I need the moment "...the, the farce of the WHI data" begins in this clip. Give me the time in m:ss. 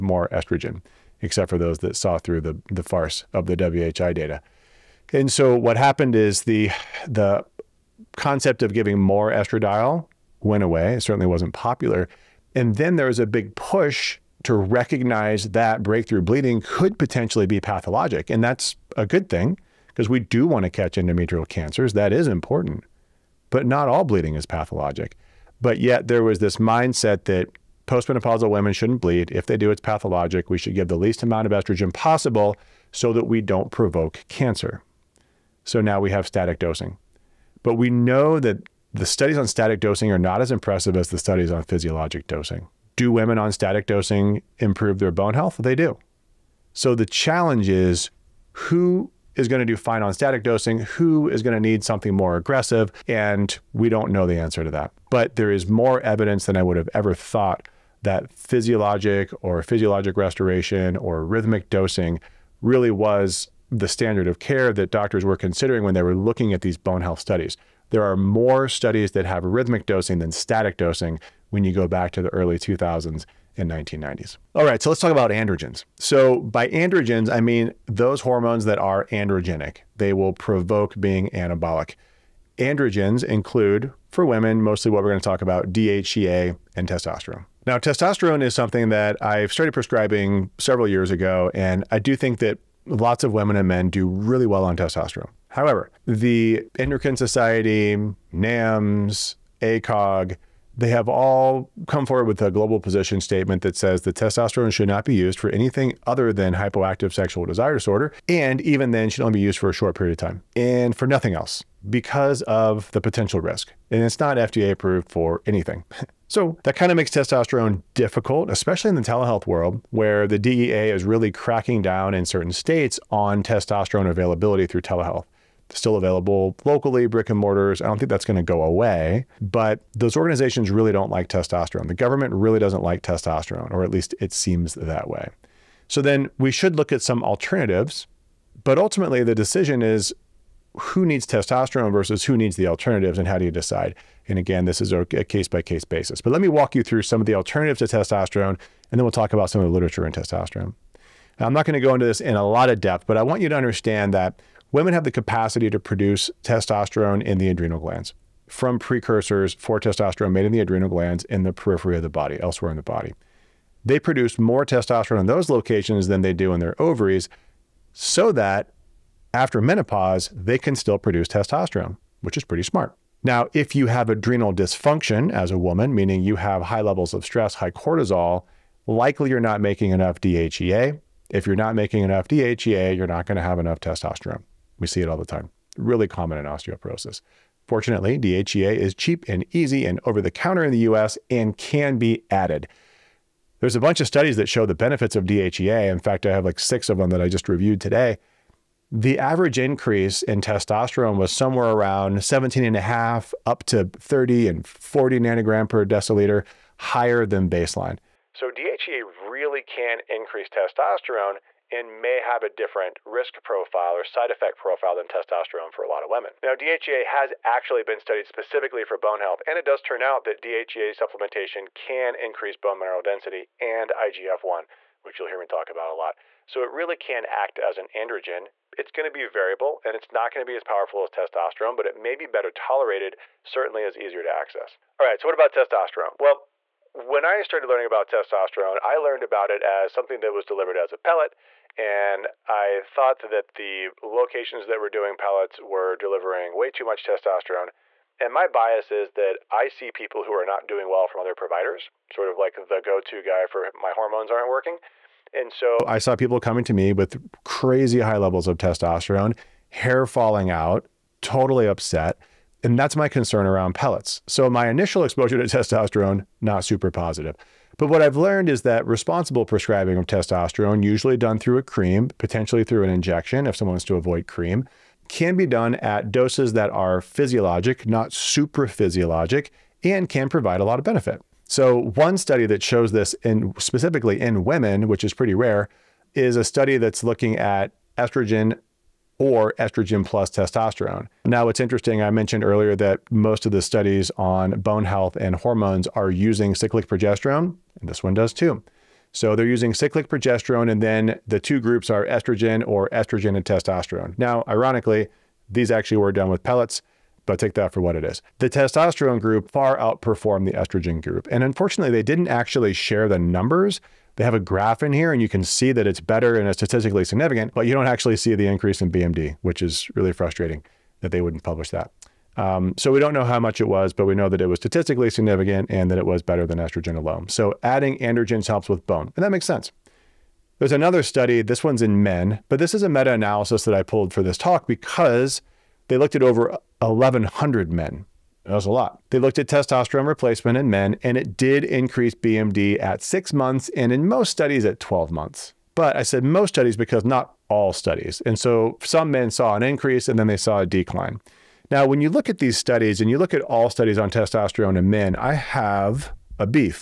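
0:02.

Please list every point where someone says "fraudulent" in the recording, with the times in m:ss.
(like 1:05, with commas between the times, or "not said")
not said.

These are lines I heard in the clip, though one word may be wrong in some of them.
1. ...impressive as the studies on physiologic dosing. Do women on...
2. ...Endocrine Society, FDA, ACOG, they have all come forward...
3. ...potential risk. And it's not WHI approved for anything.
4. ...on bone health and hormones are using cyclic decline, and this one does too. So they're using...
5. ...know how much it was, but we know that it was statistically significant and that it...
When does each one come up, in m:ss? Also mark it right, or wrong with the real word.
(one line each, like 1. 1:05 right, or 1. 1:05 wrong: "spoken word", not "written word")
1. 0:40 right
2. 1:36 wrong: "NAMS", not "FDA"
3. 1:53 wrong: "FDA", not "WHI"
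4. 4:54 wrong: "progesterone", not "decline"
5. 5:23 right.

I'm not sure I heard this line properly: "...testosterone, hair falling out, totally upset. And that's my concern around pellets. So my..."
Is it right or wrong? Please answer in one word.
right.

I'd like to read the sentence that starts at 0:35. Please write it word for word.
So now we have static dosing.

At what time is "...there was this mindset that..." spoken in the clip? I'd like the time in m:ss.
0:26.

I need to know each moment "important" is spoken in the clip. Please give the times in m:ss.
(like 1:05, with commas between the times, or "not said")
0:22.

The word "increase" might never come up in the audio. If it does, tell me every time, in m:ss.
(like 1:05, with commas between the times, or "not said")
3:19, 3:30, 3:42, 5:18, 5:41, 5:49.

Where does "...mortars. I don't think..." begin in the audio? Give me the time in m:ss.
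2:07.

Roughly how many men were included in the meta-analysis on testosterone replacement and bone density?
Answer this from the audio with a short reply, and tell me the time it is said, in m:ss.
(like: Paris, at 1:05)
1,100, at 5:36.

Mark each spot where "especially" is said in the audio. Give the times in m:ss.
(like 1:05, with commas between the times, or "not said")
1:58.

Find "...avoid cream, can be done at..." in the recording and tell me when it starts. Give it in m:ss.
4:33.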